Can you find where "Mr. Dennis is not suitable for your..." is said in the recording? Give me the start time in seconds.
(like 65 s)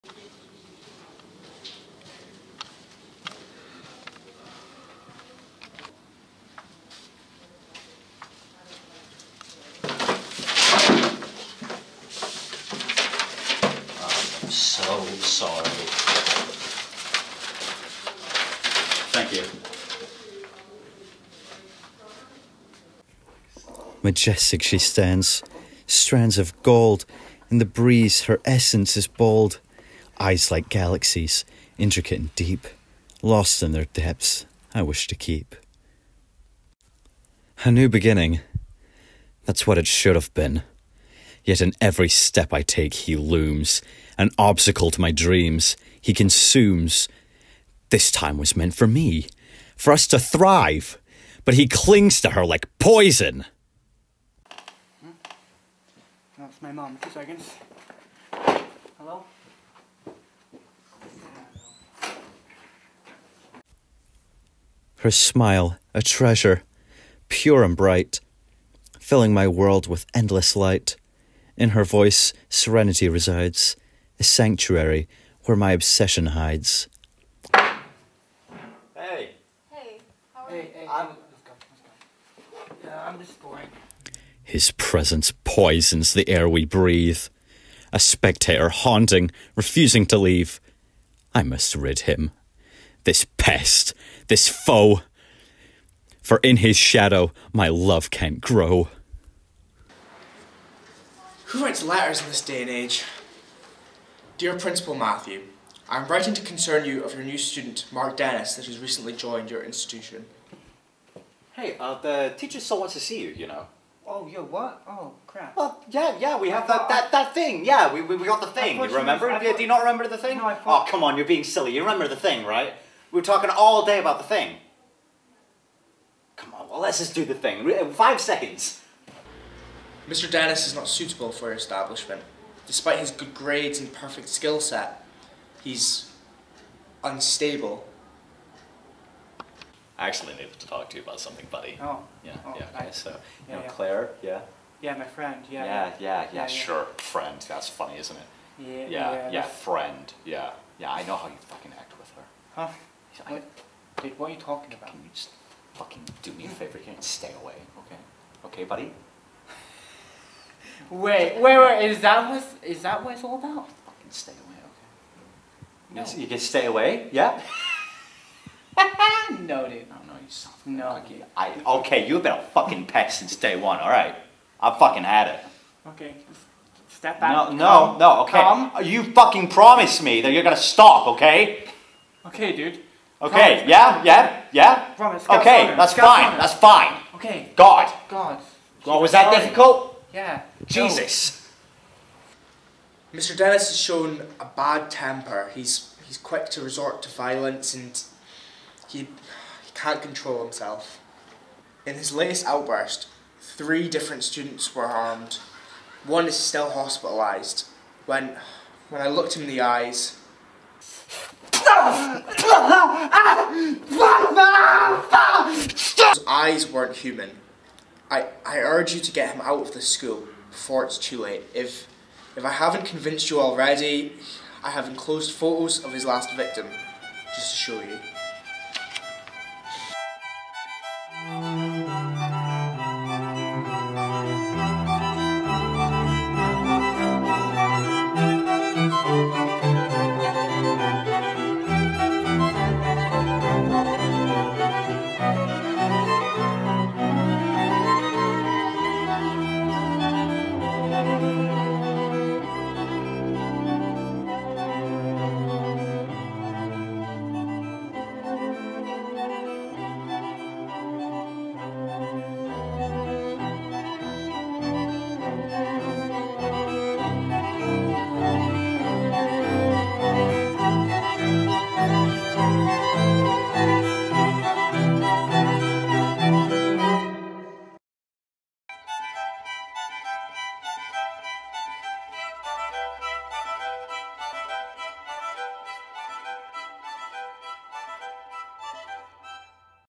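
130 s.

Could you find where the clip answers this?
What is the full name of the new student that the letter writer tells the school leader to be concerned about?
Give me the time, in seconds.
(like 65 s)
107 s.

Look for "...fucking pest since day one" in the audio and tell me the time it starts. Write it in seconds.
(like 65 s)
172 s.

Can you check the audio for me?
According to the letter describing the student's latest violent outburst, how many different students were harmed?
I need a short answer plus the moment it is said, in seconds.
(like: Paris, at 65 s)
3, at 203 s.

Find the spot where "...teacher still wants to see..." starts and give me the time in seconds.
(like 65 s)
112 s.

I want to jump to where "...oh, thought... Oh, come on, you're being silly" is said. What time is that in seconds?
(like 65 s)
120 s.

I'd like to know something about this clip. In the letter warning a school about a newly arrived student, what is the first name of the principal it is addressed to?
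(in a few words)
Matthew.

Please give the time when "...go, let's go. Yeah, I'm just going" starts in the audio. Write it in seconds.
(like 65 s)
81 s.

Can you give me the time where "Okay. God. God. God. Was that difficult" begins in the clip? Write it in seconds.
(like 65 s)
187 s.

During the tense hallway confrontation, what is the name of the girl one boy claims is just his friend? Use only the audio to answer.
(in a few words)
Claire.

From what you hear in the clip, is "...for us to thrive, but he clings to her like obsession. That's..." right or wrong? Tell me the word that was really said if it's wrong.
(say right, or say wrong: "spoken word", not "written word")
wrong: "poison", not "obsession".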